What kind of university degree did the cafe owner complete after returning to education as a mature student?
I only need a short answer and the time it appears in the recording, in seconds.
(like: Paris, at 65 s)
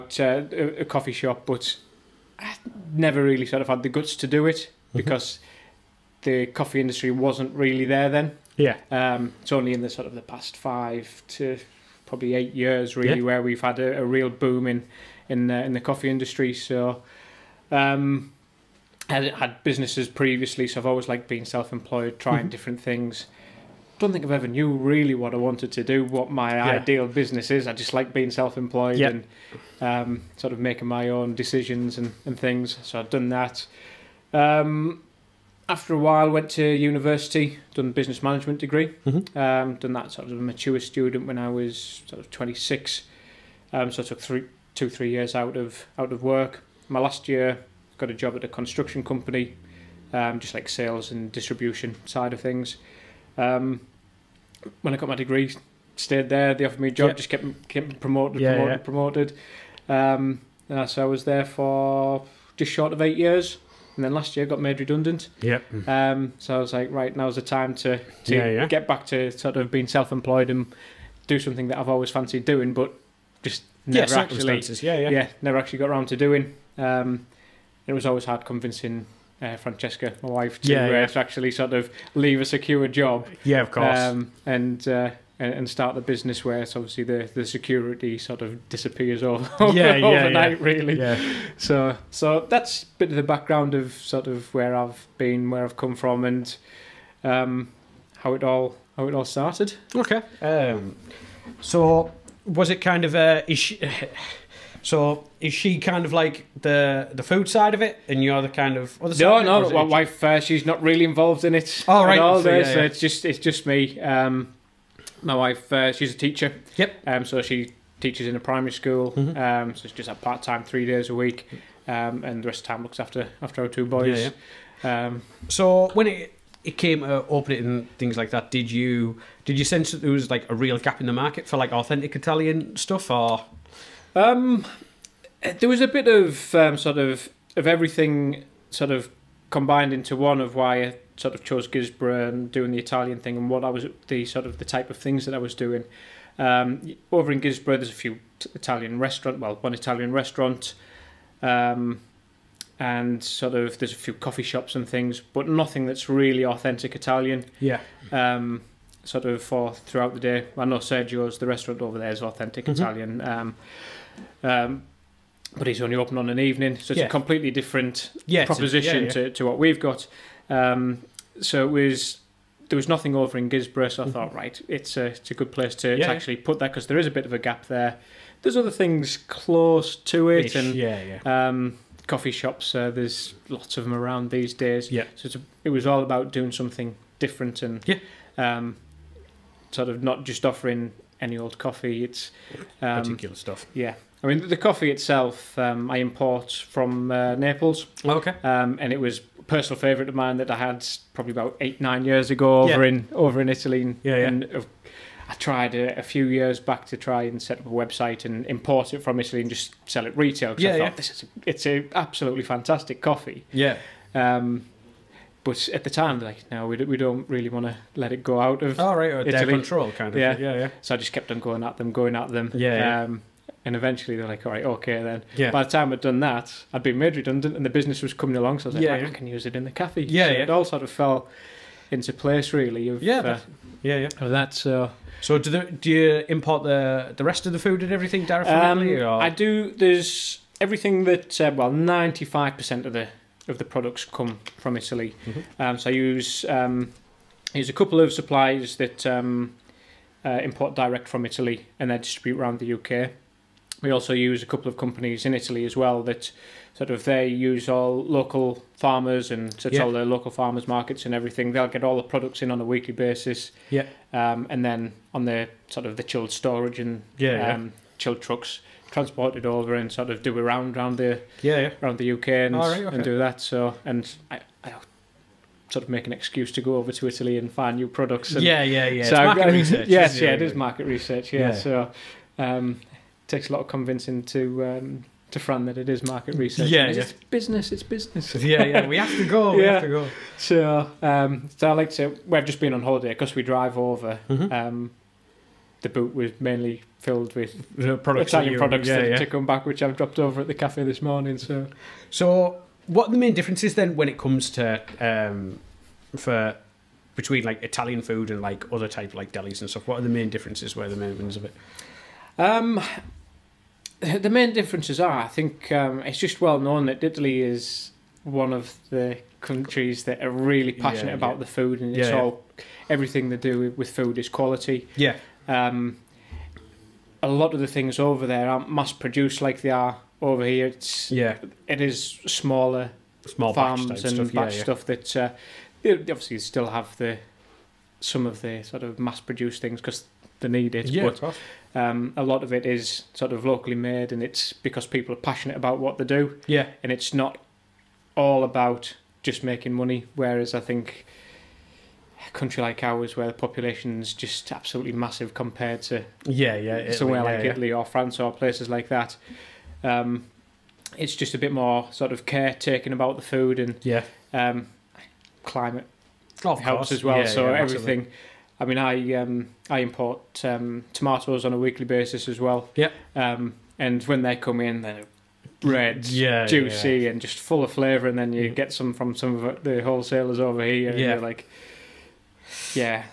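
Business management, at 37 s.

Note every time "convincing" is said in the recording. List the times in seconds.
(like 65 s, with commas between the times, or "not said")
78 s, 283 s.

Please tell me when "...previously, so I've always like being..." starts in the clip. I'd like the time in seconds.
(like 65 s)
20 s.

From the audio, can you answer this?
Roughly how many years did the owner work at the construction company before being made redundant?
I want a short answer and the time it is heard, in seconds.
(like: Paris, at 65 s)
Just short of 8 years, at 62 s.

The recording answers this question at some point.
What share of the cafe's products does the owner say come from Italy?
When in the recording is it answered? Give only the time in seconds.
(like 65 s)
241 s.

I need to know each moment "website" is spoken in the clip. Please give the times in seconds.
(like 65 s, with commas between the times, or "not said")
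207 s.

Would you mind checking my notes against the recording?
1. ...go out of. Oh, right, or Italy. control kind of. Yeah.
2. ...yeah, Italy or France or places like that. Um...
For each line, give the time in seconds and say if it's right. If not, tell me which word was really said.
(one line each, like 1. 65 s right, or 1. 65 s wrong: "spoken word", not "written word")
1. 218 s right
2. 357 s right.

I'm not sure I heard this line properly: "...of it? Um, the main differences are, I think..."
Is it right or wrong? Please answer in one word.
right.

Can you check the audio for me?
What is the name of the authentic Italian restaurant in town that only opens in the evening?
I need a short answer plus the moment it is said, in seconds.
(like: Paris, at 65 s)
Sergio's, at 160 s.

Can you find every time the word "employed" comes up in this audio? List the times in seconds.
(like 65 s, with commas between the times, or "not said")
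21 s, 28 s, 69 s.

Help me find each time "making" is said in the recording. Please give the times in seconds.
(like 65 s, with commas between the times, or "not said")
30 s, 349 s.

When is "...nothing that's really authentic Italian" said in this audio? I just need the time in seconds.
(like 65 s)
155 s.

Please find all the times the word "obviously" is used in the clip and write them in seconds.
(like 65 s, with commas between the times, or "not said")
86 s, 335 s.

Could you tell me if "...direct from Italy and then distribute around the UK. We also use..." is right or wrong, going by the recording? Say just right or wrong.
right.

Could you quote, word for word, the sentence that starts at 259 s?
all the local farmers markets and everything.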